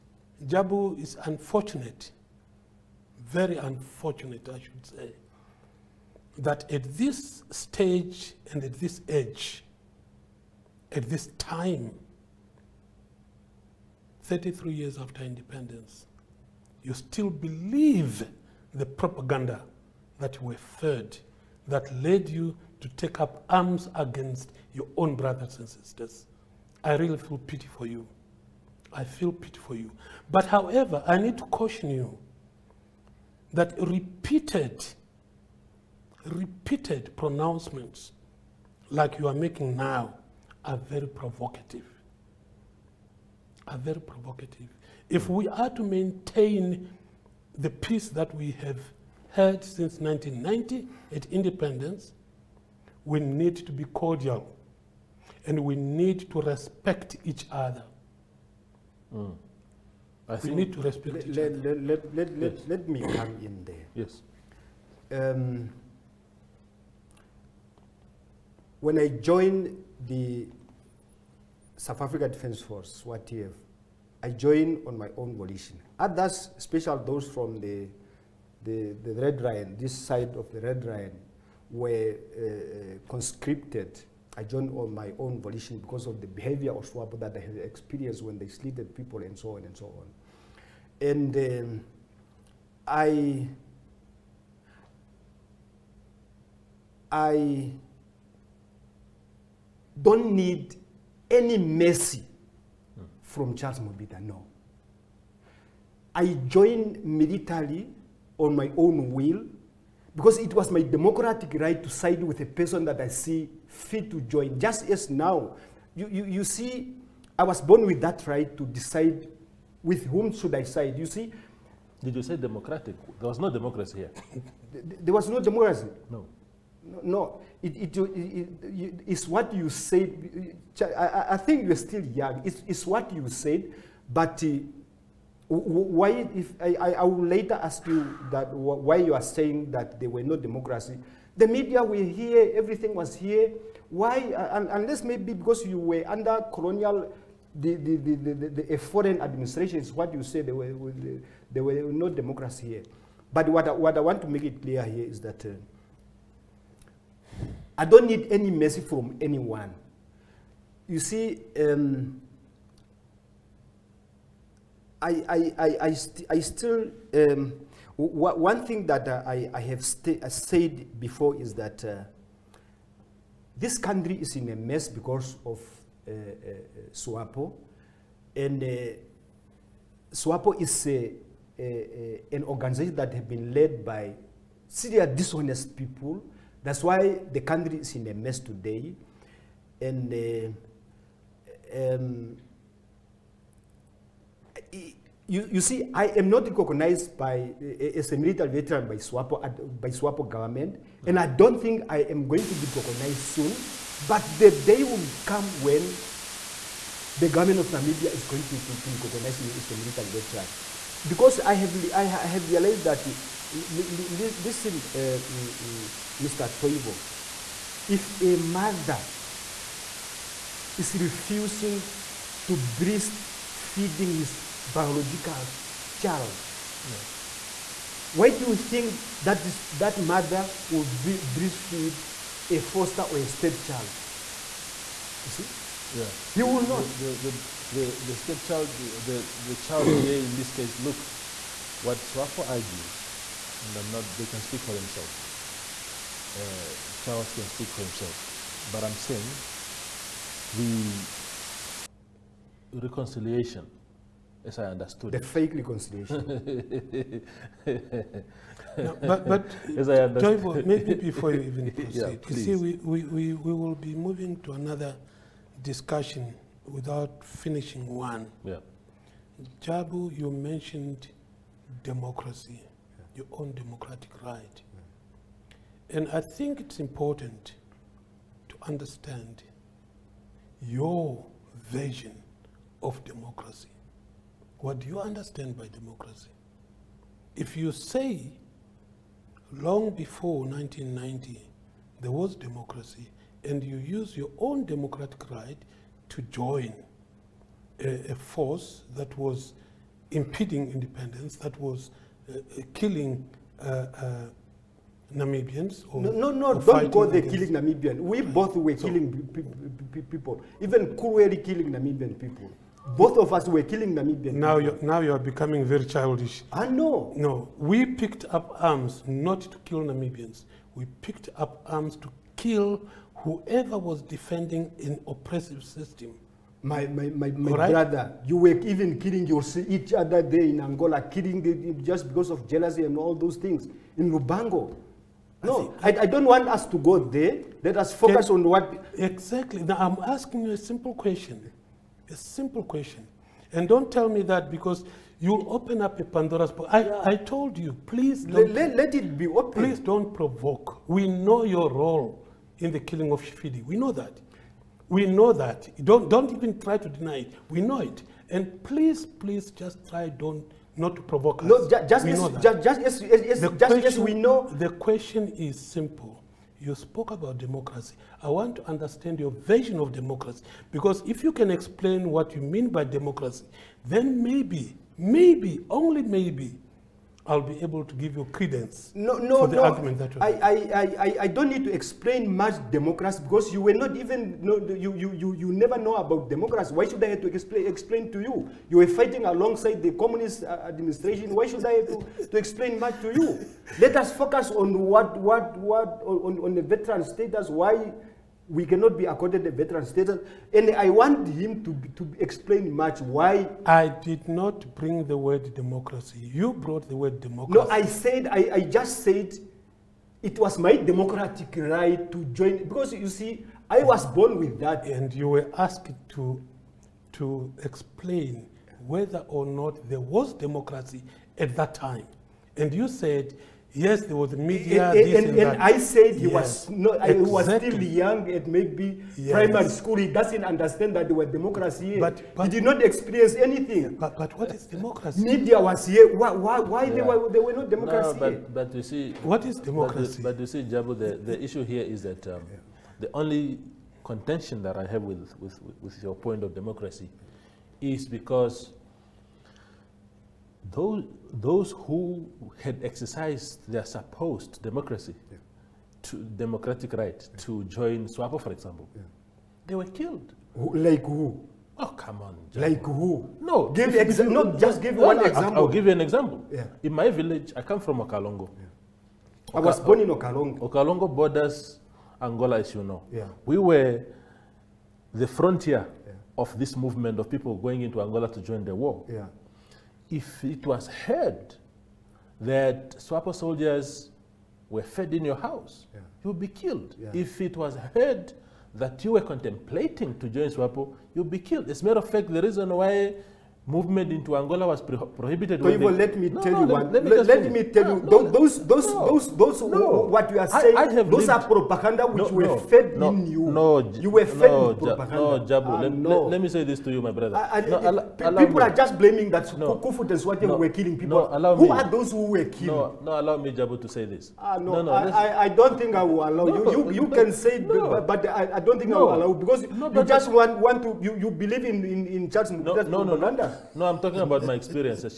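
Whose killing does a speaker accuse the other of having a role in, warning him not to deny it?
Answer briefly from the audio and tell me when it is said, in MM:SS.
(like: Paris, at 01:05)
Shifidi, at 05:53.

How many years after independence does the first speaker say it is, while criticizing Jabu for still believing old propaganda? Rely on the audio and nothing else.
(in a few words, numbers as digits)
33.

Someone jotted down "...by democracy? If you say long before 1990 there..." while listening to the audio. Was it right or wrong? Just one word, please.
right.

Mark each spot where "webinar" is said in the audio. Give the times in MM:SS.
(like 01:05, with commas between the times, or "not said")
not said.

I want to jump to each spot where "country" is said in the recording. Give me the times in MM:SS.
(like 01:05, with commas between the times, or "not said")
02:53, 03:07.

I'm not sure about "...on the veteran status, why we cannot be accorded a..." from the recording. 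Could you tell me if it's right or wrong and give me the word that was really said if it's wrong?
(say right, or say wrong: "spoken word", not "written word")
right.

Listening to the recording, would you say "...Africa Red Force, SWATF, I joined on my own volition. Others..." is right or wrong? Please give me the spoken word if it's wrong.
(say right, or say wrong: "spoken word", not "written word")
wrong: "Defence", not "Red".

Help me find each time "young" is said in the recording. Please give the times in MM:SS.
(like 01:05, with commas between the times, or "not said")
02:12, 07:07.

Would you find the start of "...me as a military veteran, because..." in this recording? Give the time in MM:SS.
03:29.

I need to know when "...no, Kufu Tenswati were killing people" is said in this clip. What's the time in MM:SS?
08:29.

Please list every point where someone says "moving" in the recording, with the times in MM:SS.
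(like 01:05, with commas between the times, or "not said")
04:23.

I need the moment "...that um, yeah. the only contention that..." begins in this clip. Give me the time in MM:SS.
07:22.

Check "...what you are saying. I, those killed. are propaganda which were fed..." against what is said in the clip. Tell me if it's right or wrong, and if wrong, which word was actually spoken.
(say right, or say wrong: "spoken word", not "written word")
wrong: "lived", not "killed".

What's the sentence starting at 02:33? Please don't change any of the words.
But what I, what I want to make it clear here is that uh, I don't need any mercy from anyone.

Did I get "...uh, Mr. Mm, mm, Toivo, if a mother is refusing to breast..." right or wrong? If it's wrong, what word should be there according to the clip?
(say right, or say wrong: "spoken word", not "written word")
right.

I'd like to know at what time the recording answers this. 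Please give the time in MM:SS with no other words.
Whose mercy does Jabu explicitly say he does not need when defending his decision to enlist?
01:43.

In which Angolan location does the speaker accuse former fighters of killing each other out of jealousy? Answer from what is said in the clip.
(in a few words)
Lubango.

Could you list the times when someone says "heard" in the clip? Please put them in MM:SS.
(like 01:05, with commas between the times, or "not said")
08:00, 08:07.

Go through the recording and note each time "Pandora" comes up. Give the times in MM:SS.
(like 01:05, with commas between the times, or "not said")
05:46.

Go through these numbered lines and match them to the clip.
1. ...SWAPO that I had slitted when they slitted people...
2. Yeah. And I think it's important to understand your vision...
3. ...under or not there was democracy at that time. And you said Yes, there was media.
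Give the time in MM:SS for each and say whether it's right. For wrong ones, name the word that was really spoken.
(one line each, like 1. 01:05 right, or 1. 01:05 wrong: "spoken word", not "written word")
1. 01:26 wrong: "experienced", not "slitted"
2. 04:35 right
3. 06:58 wrong: "whether", not "under".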